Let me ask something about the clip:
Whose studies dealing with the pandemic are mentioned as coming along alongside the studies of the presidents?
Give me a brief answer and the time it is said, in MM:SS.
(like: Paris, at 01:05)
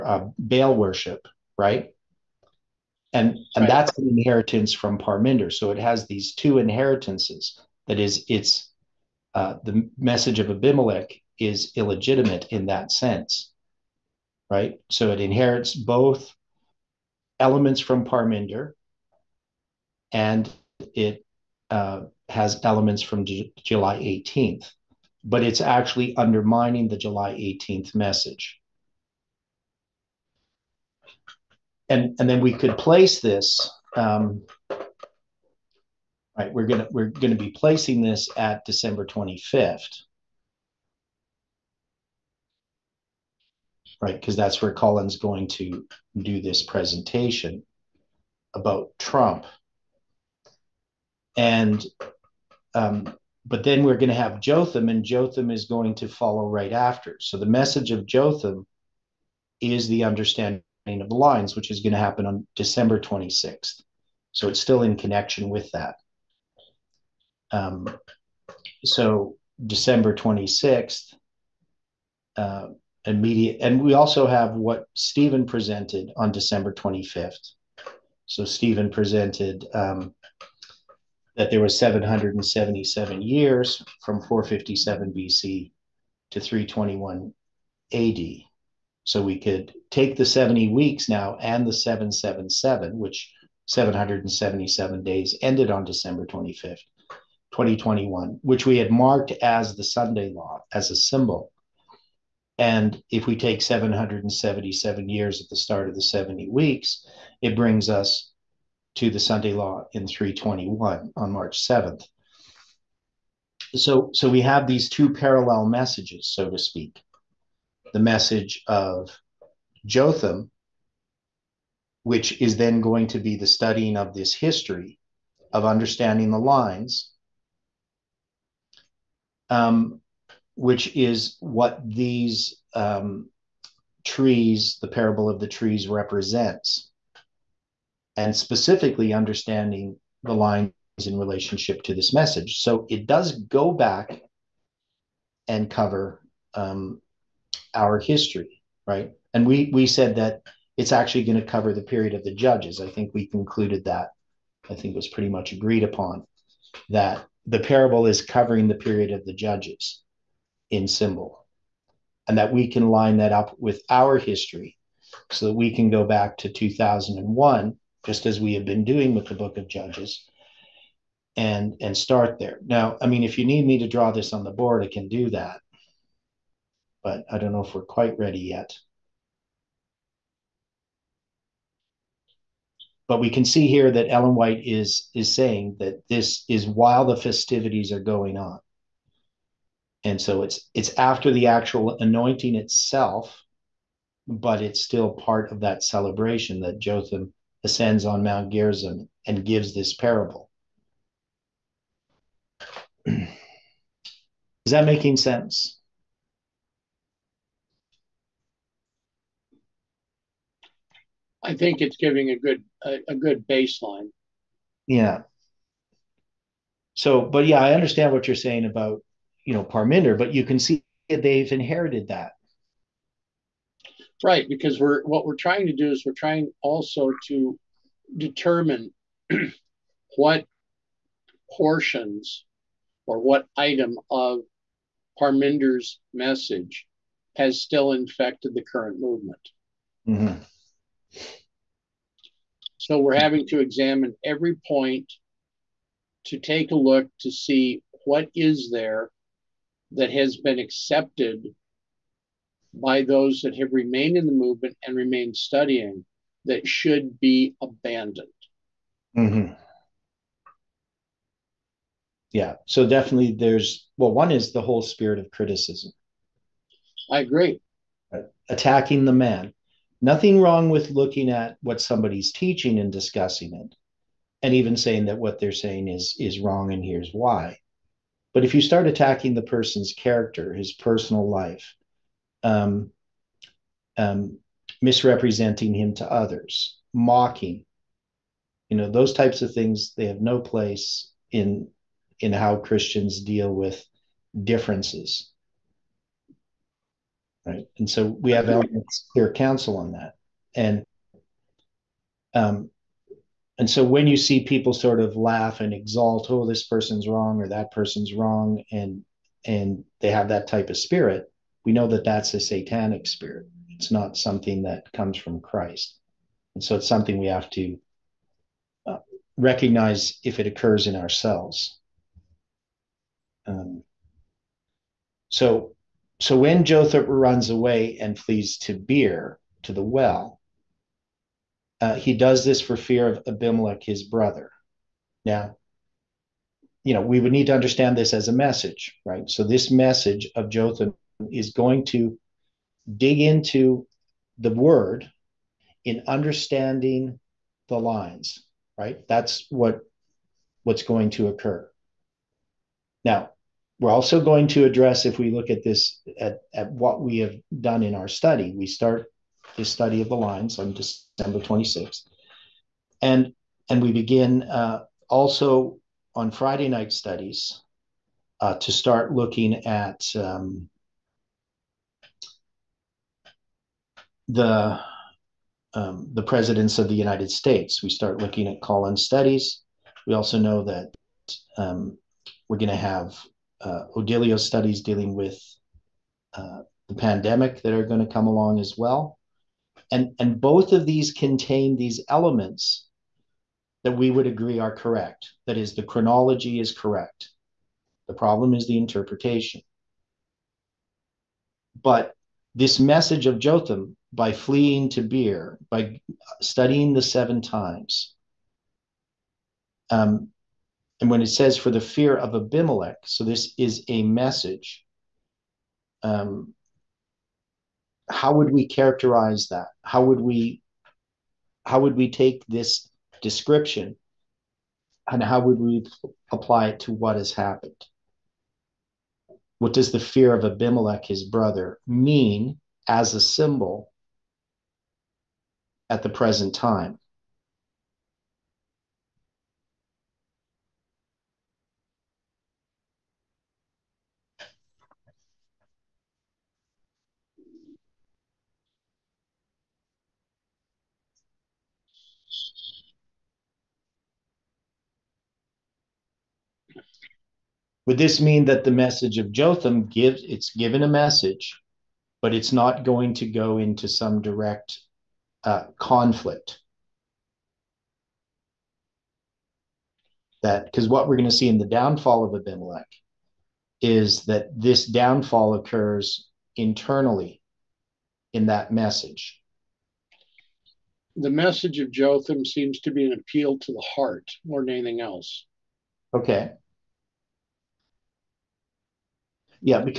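Odilio, at 06:23.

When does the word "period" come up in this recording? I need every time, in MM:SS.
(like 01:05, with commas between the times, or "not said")
02:31, 02:38.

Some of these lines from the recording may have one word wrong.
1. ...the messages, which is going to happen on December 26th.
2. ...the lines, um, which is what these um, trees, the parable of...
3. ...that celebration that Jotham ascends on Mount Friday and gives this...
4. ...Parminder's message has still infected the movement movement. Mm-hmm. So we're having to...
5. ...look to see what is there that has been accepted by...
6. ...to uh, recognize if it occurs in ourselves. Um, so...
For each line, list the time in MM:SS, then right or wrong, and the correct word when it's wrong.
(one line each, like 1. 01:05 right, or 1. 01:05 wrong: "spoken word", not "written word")
1. 01:01 wrong: "lines", not "messages"
2. 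02:06 right
3. 03:15 wrong: "Gerizim", not "Friday"
4. 03:55 wrong: "current", not "movement"
5. 04:06 right
6. 05:17 right.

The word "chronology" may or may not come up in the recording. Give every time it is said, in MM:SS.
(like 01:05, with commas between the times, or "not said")
06:35.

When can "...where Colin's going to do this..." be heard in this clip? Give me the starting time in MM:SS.
00:44.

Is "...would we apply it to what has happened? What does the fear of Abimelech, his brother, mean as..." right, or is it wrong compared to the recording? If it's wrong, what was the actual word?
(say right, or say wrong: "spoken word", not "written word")
right.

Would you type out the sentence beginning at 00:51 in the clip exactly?
And um, but then we're going to have Jotham, and Jotham is going to follow right after.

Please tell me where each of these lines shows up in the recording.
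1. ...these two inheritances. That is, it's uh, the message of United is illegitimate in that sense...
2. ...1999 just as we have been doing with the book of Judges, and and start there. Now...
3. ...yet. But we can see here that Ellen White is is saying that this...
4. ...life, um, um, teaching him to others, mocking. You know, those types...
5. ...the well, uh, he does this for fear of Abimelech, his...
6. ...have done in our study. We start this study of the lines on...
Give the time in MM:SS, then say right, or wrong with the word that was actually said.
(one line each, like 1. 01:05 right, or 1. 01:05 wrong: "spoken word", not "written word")
1. 00:06 wrong: "Abimelech", not "United"
2. 02:46 wrong: "2001", not "1999"
3. 02:58 right
4. 04:41 wrong: "misrepresenting", not "teaching"
5. 05:29 right
6. 05:57 right.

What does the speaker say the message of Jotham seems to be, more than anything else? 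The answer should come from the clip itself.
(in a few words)
an appeal to the heart.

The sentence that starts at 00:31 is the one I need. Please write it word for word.
And, and then we could place this, um, right, we're gonna, we're gonna be placing this at December 25th.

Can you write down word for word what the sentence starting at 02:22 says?
So it does go back and cover um, our history, right?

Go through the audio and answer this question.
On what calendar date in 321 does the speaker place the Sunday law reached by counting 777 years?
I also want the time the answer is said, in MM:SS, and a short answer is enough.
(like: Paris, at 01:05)
March 7th, at 01:51.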